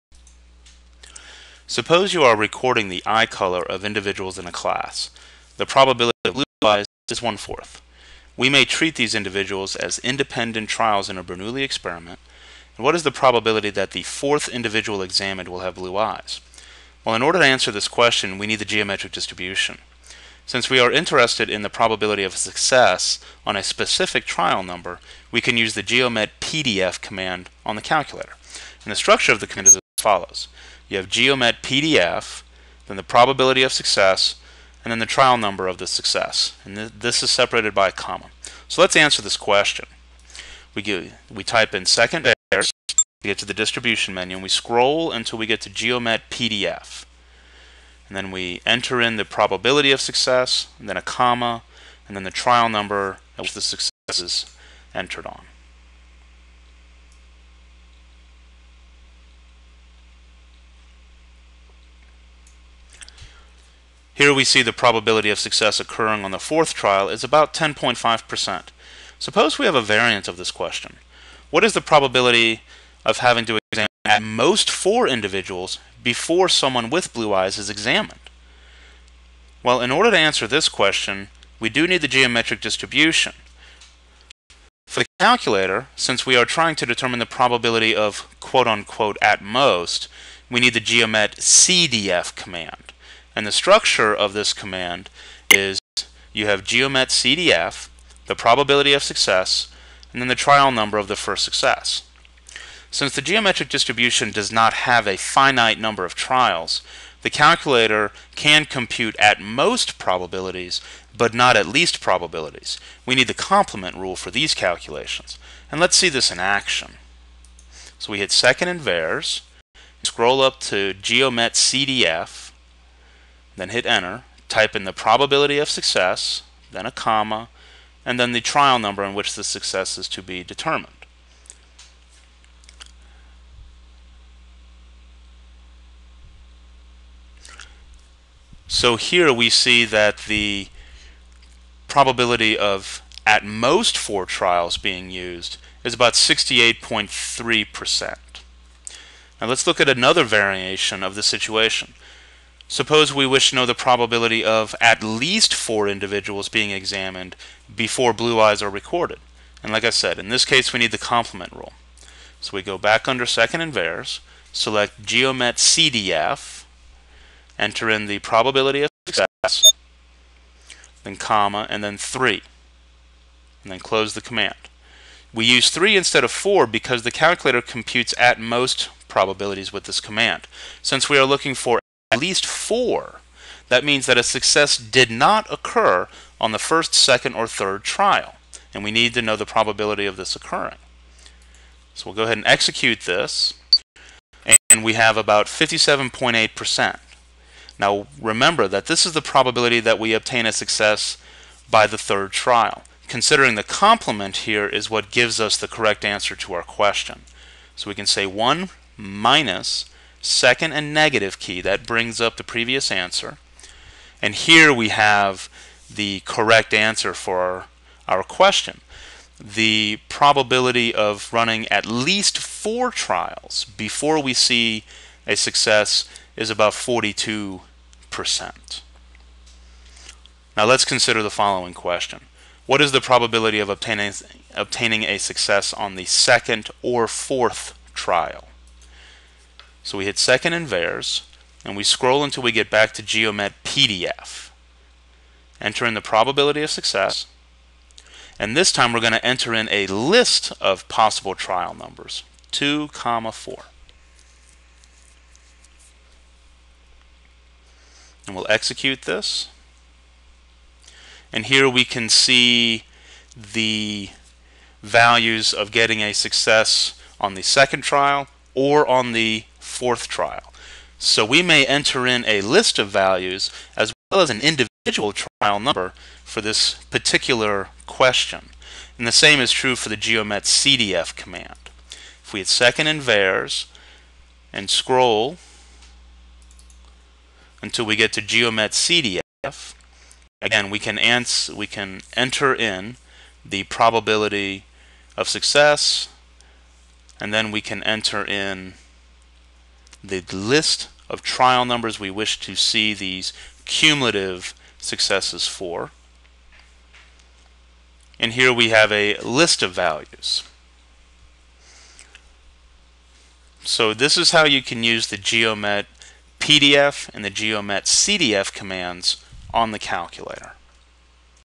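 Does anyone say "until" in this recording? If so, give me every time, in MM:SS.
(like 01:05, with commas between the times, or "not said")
00:45, 04:02, 04:47.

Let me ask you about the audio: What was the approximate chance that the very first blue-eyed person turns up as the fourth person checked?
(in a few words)
10.5%.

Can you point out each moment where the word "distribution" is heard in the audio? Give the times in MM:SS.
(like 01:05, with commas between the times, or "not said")
00:19, 00:43, 01:22, 01:43.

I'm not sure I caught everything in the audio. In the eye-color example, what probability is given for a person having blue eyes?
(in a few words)
1/4.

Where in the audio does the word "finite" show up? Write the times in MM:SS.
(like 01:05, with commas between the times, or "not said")
01:45.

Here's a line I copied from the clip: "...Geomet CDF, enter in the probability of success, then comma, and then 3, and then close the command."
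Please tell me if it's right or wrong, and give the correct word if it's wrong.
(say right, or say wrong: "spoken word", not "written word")
right.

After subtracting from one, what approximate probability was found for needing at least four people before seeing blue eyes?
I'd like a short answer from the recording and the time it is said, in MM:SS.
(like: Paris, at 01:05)
42%, at 03:46.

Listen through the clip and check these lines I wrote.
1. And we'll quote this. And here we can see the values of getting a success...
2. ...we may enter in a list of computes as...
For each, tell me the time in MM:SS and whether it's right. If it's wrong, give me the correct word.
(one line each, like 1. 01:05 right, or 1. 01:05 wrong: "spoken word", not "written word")
1. 04:18 wrong: "execute", not "quote"
2. 04:31 wrong: "values", not "computes".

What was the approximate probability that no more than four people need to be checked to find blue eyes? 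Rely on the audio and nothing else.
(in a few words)
68.3%.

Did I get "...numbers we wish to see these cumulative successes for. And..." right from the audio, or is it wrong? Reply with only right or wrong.
right.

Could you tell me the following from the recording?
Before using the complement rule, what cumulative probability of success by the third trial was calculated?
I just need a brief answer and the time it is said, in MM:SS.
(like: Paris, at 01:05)
57.8%, at 03:15.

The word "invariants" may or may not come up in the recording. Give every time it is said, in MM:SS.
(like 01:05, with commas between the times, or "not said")
02:43.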